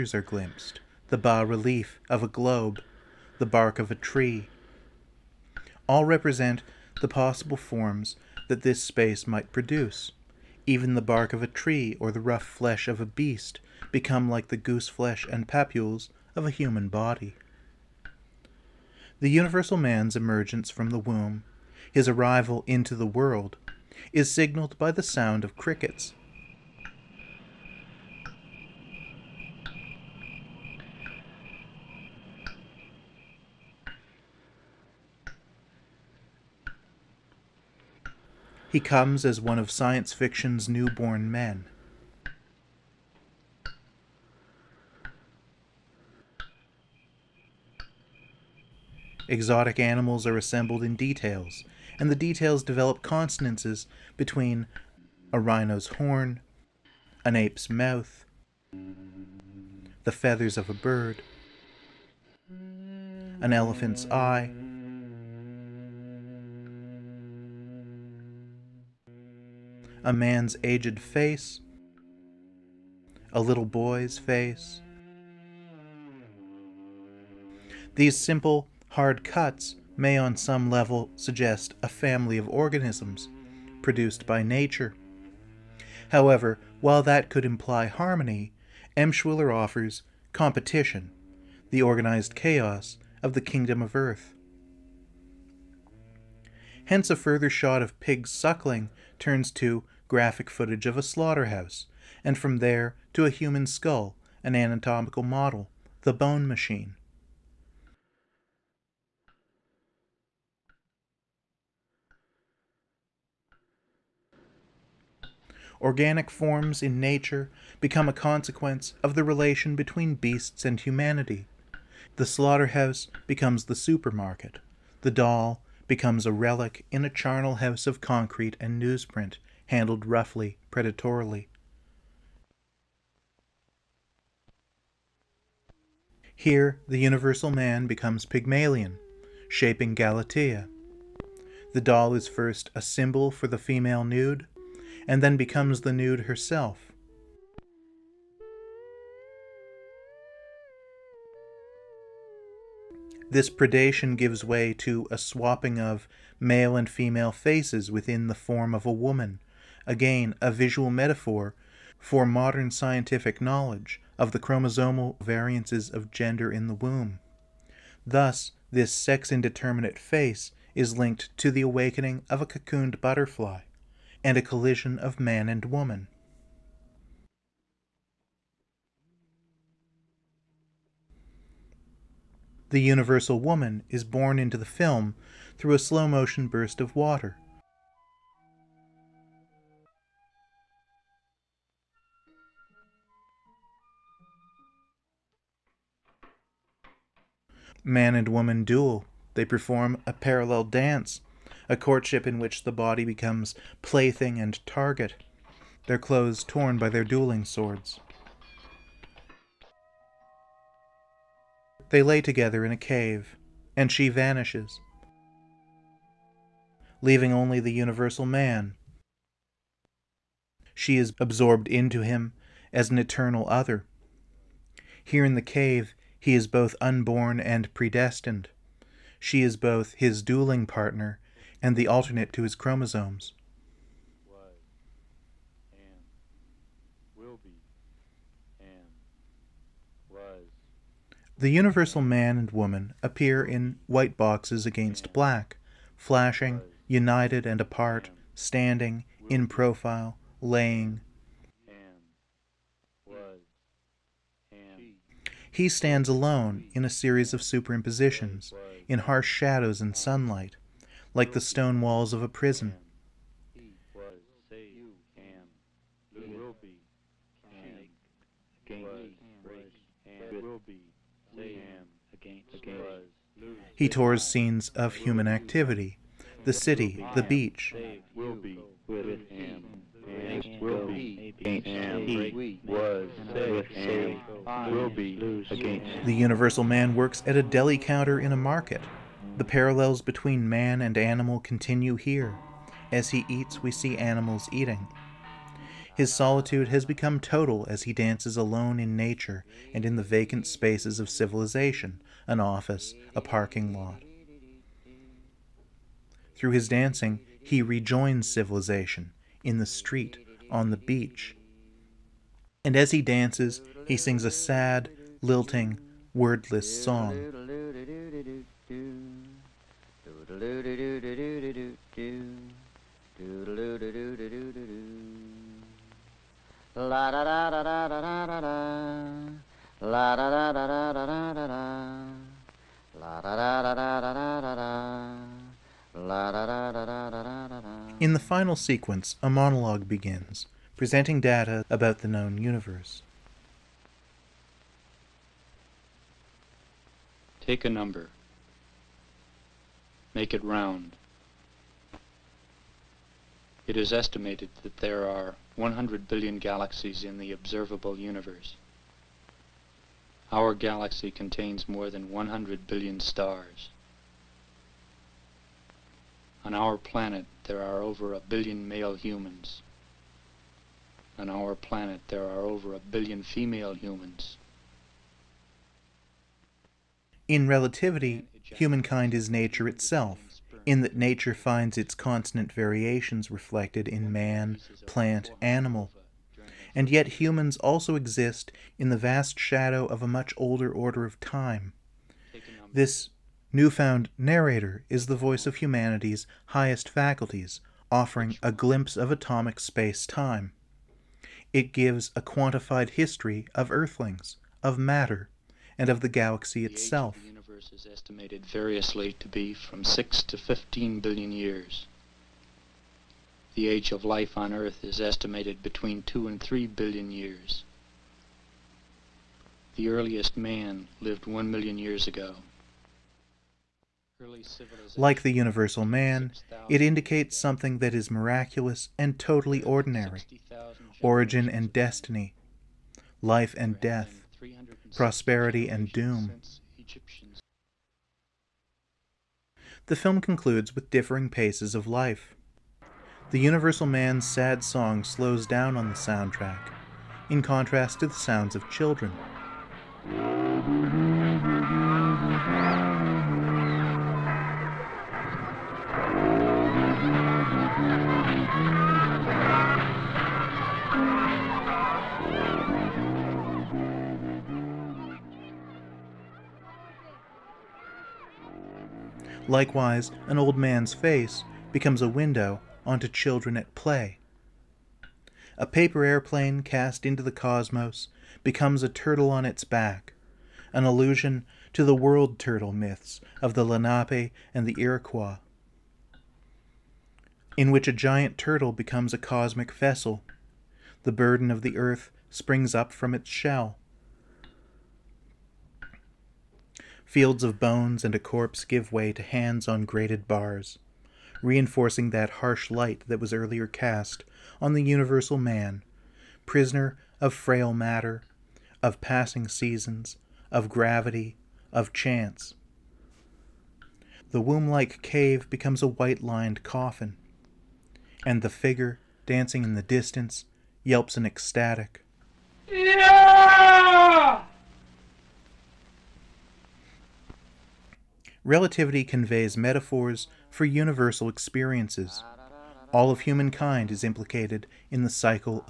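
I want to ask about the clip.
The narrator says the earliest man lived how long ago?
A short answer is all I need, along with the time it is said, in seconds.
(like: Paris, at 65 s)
1 million years, at 421 s.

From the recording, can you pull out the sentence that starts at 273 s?
He tours scenes of human activity, the city, the beach.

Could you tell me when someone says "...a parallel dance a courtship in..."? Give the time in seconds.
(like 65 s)
200 s.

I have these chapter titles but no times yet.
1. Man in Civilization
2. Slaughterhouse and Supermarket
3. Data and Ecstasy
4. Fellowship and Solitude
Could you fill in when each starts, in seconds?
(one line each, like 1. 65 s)
1. 240 s
2. 121 s
3. 333 s
4. 525 s.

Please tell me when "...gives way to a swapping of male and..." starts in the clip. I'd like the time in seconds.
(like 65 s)
154 s.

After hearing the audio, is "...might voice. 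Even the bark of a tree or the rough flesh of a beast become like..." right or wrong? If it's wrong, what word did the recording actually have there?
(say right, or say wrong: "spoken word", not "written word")
wrong: "produce", not "voice".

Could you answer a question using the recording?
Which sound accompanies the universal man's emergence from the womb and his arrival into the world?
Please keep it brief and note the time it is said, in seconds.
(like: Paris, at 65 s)
Crickets, at 24 s.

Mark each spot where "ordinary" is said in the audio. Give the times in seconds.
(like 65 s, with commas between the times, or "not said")
429 s.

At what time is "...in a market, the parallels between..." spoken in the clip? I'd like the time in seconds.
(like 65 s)
288 s.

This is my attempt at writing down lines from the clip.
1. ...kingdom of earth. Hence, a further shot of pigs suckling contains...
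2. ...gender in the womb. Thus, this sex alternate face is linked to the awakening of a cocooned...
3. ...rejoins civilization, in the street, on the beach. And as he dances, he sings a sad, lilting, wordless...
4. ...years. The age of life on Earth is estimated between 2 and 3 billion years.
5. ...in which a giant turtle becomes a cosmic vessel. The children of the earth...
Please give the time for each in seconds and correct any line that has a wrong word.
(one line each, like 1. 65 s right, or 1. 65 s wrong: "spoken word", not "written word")
1. 93 s wrong: "turns", not "contains"
2. 166 s wrong: "indeterminate", not "alternate"
3. 307 s right
4. 411 s right
5. 487 s wrong: "burden", not "children".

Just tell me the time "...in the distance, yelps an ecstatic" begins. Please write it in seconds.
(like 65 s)
519 s.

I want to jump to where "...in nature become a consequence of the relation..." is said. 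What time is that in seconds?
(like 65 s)
116 s.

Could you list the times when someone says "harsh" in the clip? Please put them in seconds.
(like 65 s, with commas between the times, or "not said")
258 s, 502 s.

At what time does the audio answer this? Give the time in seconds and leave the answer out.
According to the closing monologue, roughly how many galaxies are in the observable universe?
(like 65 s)
355 s.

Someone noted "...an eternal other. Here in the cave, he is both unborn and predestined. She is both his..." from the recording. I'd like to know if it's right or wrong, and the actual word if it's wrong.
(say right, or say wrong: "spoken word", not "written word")
right.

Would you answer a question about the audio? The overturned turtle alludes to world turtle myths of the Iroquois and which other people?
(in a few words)
Lenape.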